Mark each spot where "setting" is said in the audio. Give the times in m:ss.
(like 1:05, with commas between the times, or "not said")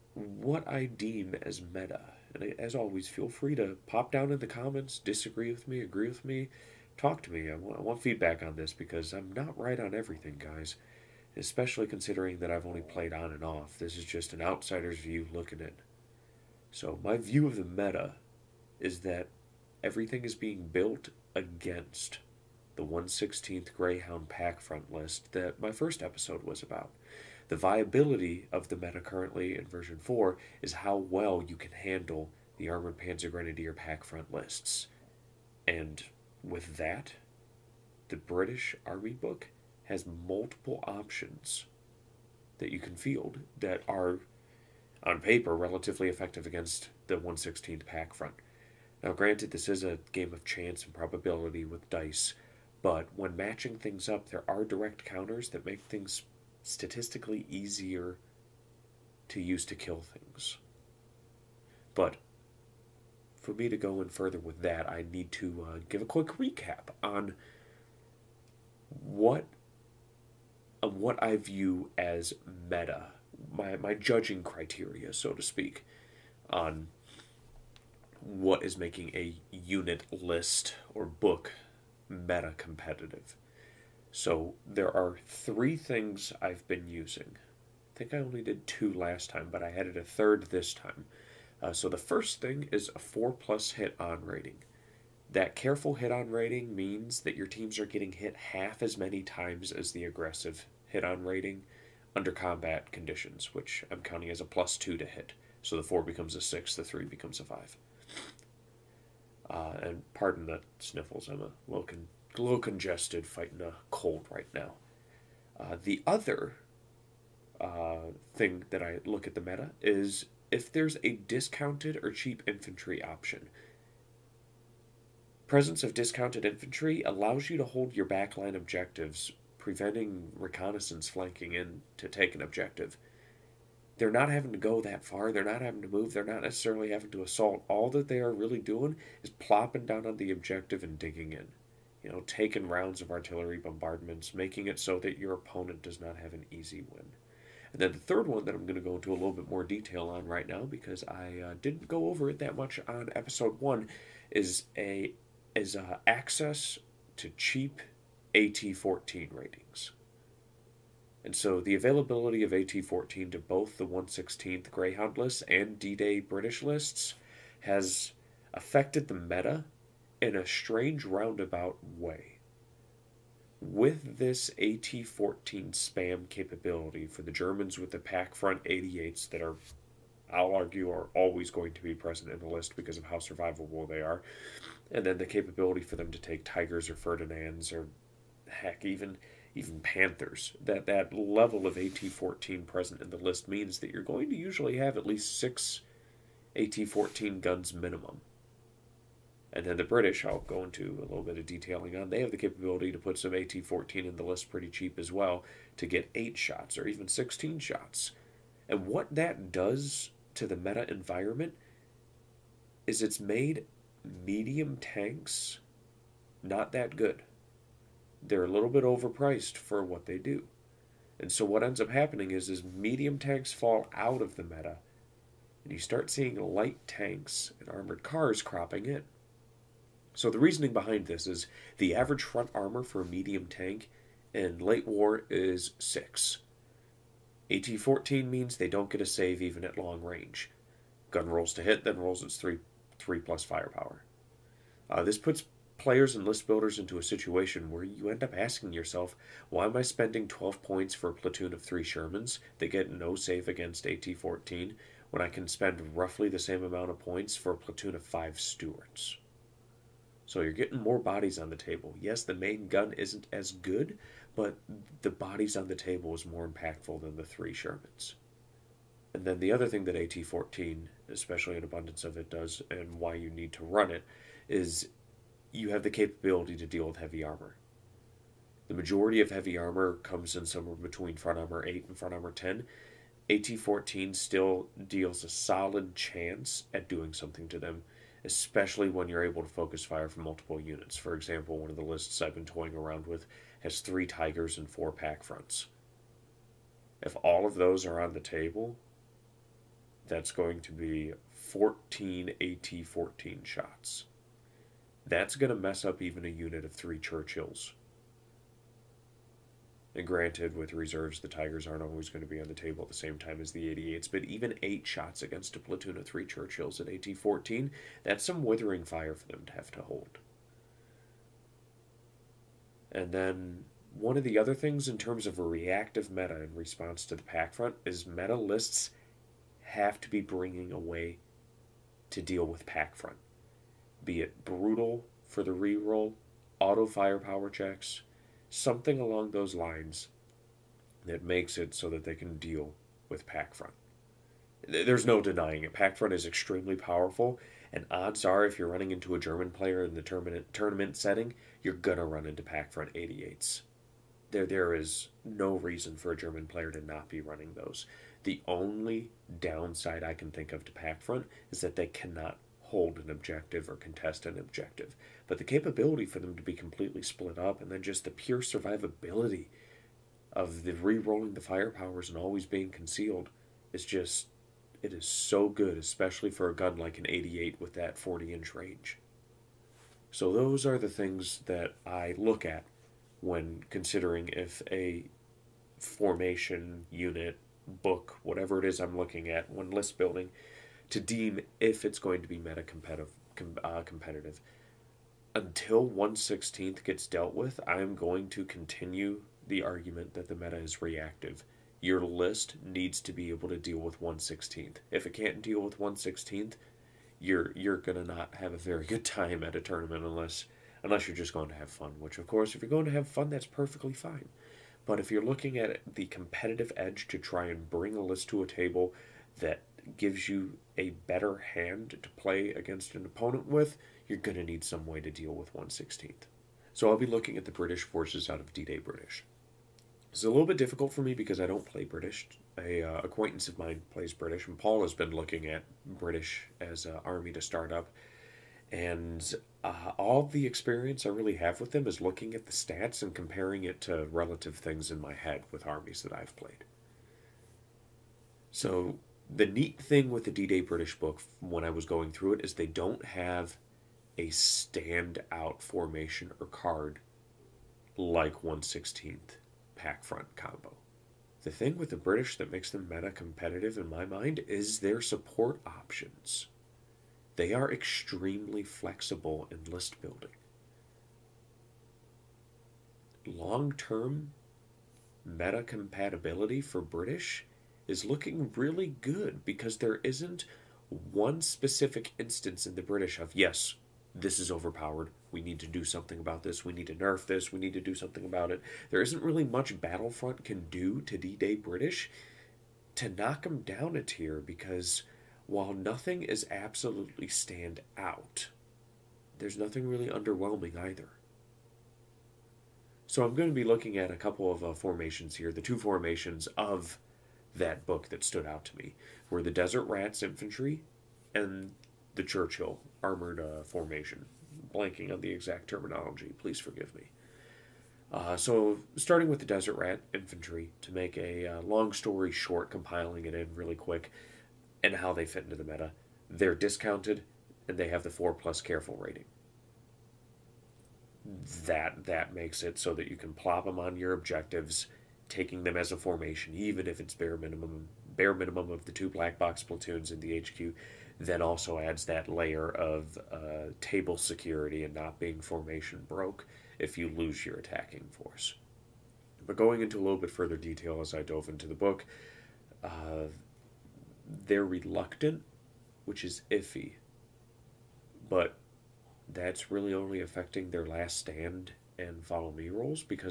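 5:50.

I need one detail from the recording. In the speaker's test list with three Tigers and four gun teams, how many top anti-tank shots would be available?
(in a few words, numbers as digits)
14.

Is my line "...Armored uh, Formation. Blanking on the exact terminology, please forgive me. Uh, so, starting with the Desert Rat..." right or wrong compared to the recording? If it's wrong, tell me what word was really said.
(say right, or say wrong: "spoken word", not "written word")
right.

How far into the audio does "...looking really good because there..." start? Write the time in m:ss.
7:58.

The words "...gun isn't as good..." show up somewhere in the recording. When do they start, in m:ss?
4:22.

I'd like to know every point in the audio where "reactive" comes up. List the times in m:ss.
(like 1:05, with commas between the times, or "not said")
5:25, 6:40.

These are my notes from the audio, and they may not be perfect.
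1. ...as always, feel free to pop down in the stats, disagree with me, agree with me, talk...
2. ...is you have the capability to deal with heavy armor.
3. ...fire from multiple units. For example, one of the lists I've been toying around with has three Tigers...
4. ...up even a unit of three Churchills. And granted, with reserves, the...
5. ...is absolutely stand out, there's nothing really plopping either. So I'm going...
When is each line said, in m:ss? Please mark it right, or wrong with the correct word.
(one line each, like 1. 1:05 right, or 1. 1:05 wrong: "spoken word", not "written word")
1. 0:02 wrong: "comments", not "stats"
2. 4:34 right
3. 4:49 right
4. 5:05 right
5. 8:16 wrong: "underwhelming", not "plopping".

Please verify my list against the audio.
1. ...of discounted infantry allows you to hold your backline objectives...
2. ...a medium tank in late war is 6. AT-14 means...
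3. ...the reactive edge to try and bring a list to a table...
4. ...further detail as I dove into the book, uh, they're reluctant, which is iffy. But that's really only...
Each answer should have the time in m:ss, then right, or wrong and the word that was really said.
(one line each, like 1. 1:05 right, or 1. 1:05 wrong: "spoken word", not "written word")
1. 2:05 right
2. 3:52 right
3. 6:55 wrong: "competitive", not "reactive"
4. 9:10 right.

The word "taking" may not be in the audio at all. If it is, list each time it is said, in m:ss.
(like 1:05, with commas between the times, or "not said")
2:22, 8:55.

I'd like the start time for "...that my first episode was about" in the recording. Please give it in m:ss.
0:25.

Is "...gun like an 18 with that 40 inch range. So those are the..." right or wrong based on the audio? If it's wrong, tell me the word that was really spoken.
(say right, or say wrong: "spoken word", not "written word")
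wrong: "88", not "18".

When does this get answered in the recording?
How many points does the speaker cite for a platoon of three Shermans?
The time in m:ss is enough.
4:10.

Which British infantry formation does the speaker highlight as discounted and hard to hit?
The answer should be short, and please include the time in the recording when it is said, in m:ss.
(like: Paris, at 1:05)
Desert Rats Infantry, at 8:29.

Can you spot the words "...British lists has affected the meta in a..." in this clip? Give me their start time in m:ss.
2:46.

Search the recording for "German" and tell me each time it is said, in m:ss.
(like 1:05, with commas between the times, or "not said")
2:57, 5:49, 5:56.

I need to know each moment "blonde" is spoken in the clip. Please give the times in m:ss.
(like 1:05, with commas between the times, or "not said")
not said.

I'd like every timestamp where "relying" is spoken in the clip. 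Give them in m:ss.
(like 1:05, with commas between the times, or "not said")
not said.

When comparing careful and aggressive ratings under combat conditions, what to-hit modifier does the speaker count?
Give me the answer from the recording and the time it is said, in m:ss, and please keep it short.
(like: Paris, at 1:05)
plus two, at 1:44.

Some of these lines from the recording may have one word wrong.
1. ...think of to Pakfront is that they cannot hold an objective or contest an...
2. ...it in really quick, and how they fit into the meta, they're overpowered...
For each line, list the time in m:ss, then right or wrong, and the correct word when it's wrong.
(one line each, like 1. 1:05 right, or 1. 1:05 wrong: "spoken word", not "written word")
1. 6:00 right
2. 8:43 wrong: "discounted", not "overpowered".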